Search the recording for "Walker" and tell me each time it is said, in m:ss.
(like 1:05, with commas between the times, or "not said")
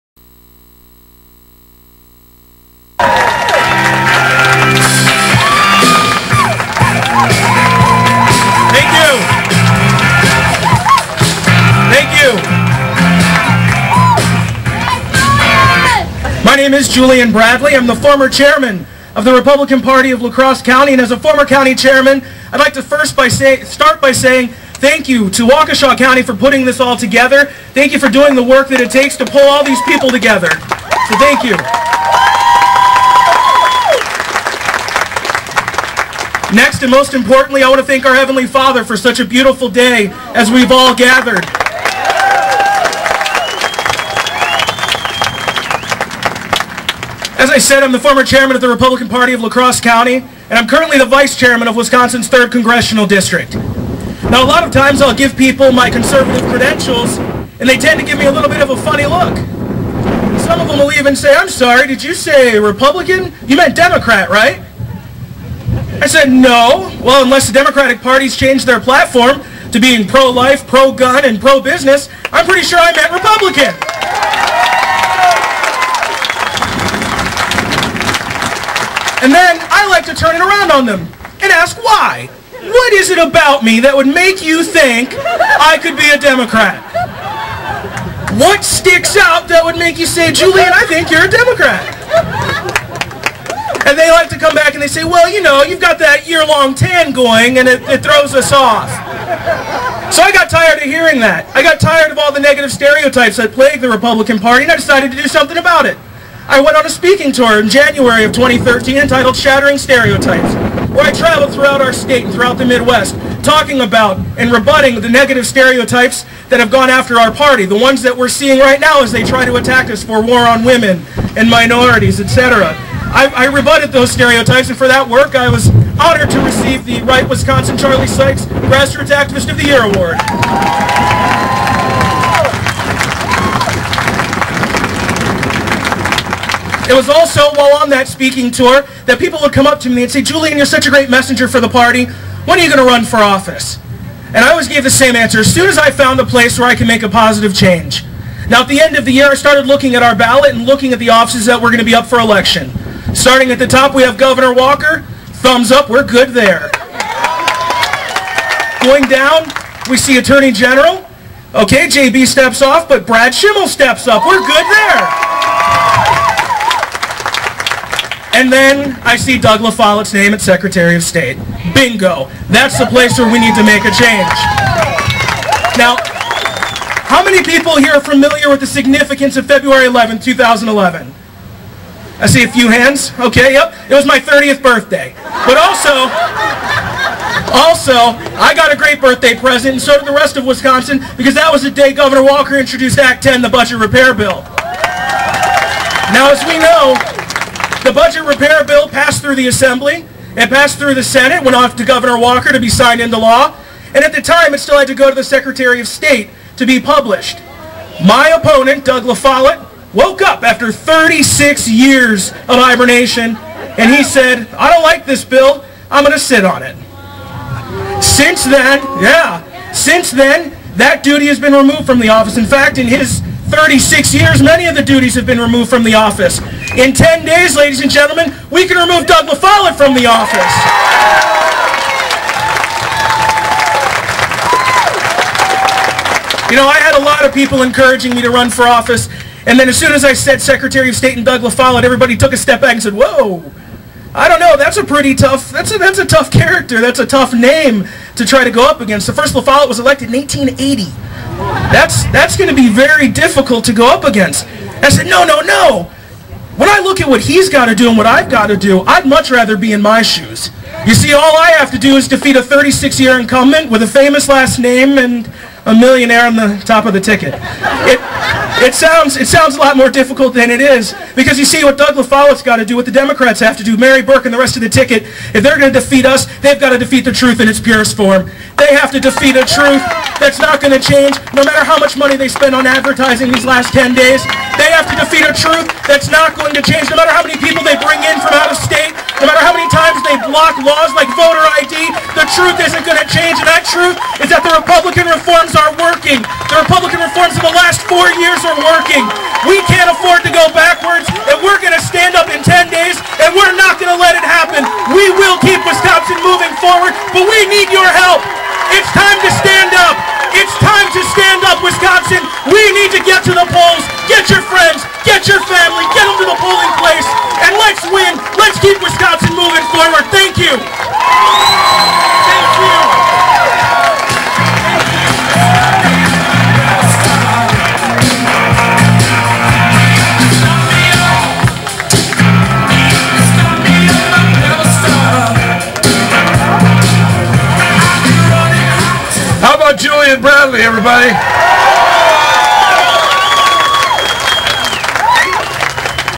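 2:34, 3:12, 3:22.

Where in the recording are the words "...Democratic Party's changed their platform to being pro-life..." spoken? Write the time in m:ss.
1:07.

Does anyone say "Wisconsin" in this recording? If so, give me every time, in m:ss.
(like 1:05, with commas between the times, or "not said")
0:51, 2:07, 3:10, 5:05, 5:11, 5:18.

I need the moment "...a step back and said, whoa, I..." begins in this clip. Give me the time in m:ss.
4:02.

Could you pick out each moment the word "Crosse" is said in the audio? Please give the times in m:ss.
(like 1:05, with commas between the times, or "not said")
0:20, 0:49.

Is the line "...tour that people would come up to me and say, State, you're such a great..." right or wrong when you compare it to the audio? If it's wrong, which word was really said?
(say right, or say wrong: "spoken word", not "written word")
wrong: "Julian", not "State".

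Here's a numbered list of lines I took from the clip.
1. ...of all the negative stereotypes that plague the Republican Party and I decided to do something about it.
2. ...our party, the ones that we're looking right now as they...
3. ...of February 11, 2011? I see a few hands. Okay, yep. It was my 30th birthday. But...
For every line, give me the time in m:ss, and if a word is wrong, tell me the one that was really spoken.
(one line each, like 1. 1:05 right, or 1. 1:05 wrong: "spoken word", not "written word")
1. 1:42 right
2. 1:57 wrong: "seeing", not "looking"
3. 2:59 right.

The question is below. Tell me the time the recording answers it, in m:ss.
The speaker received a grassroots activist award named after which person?
2:07.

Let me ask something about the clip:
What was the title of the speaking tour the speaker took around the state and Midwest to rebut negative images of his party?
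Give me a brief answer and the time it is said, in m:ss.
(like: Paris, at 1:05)
Shattering Stereotypes, at 1:49.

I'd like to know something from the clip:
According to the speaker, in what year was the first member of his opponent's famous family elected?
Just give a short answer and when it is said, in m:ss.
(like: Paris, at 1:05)
1880, at 4:10.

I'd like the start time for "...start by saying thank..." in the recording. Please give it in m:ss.
0:23.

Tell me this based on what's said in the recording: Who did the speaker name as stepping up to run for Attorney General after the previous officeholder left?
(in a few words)
Brad Schimel.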